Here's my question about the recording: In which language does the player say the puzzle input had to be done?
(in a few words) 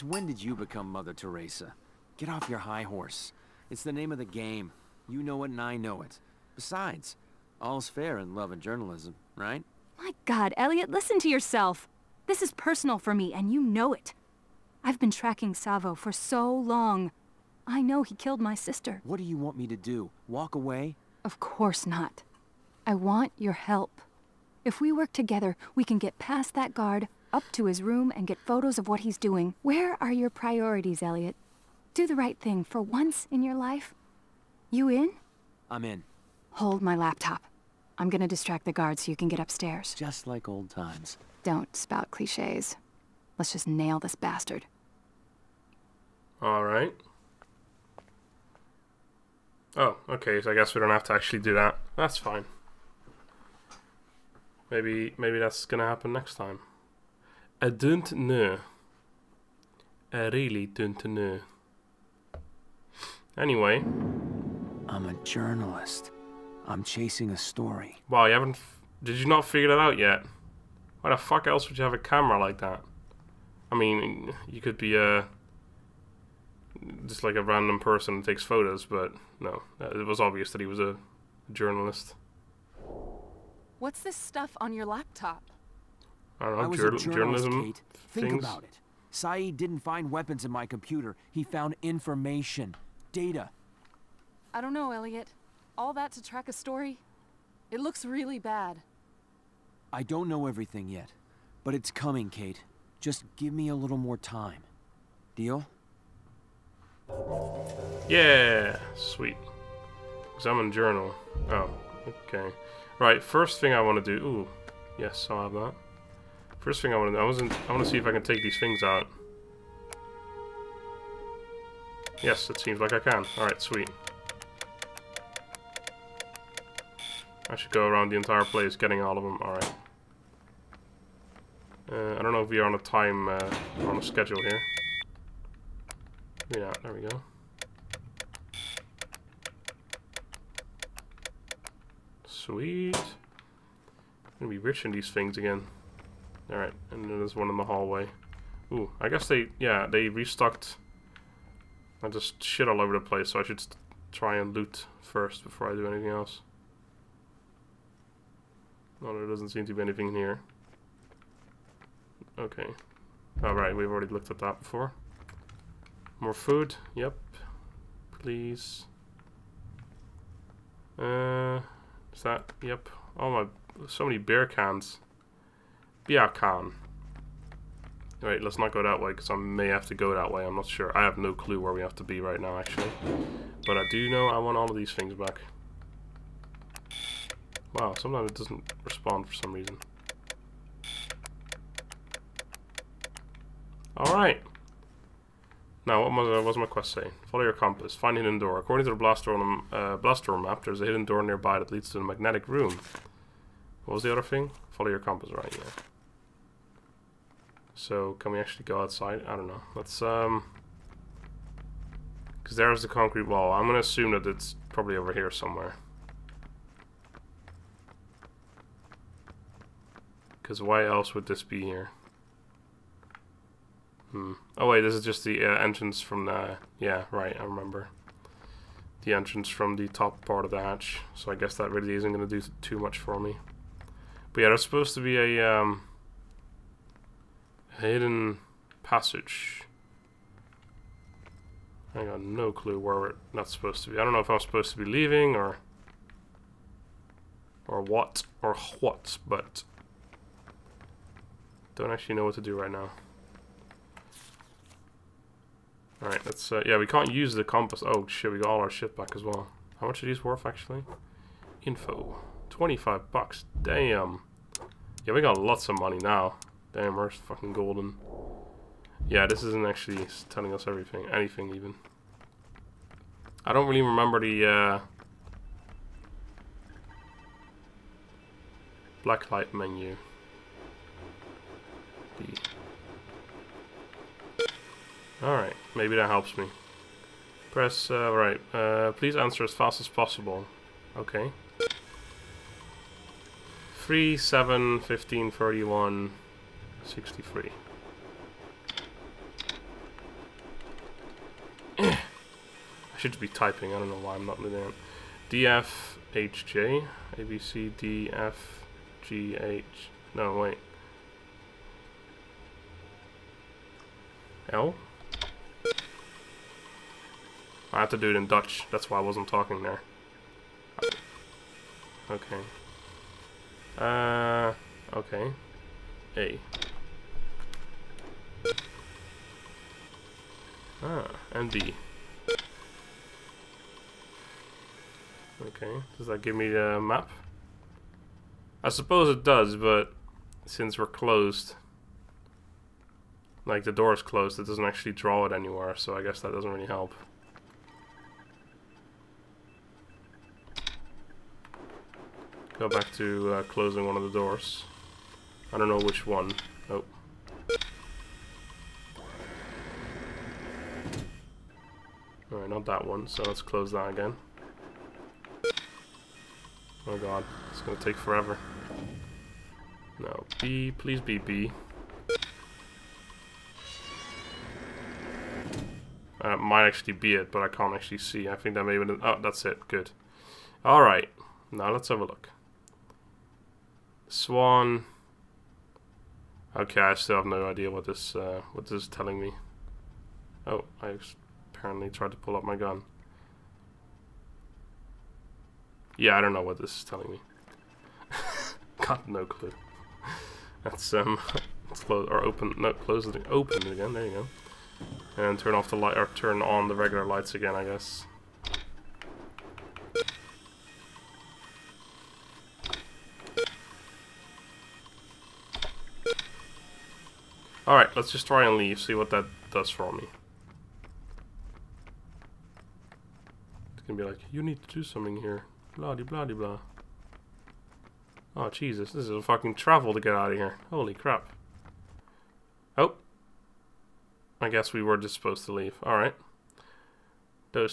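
Dutch.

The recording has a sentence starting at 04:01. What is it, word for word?
I got no clue where we're not supposed to be.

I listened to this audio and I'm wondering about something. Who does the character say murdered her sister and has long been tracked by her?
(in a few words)
Savo.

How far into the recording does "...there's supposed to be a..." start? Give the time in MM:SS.
03:54.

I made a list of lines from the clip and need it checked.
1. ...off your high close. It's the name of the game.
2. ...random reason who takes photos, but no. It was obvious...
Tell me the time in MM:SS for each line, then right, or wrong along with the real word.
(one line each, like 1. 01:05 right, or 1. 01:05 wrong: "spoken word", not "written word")
1. 00:02 wrong: "horse", not "close"
2. 01:17 wrong: "person", not "reason".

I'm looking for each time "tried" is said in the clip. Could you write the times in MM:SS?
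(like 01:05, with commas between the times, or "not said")
06:31.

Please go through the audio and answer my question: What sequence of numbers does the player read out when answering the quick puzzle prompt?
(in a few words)
3, 7, 15, 31, 63.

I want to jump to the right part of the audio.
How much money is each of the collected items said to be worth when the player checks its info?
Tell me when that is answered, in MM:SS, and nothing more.
04:22.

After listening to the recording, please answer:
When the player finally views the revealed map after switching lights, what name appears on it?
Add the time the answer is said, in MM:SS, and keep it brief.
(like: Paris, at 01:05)
Swan, at 06:24.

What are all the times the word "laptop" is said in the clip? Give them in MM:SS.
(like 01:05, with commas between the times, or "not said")
00:36, 01:24.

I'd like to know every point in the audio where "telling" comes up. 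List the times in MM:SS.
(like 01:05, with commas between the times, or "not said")
04:30, 06:28, 06:36.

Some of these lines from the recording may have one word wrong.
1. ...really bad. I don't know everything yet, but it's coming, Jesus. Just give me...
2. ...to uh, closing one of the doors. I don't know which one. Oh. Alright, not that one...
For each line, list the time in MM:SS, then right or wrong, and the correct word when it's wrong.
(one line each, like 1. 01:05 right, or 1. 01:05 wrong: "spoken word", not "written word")
1. 01:38 wrong: "Kate", not "Jesus"
2. 05:52 right.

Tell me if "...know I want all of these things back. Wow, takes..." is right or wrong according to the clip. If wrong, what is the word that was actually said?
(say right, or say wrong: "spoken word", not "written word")
wrong: "sometimes", not "takes".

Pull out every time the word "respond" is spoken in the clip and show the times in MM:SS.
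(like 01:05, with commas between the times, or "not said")
03:08.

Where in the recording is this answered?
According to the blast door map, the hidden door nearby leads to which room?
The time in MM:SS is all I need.
03:22.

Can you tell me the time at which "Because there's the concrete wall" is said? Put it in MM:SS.
03:32.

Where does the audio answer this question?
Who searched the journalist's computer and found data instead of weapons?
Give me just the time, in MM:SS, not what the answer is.
01:29.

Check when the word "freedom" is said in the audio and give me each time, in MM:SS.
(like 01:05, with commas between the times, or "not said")
not said.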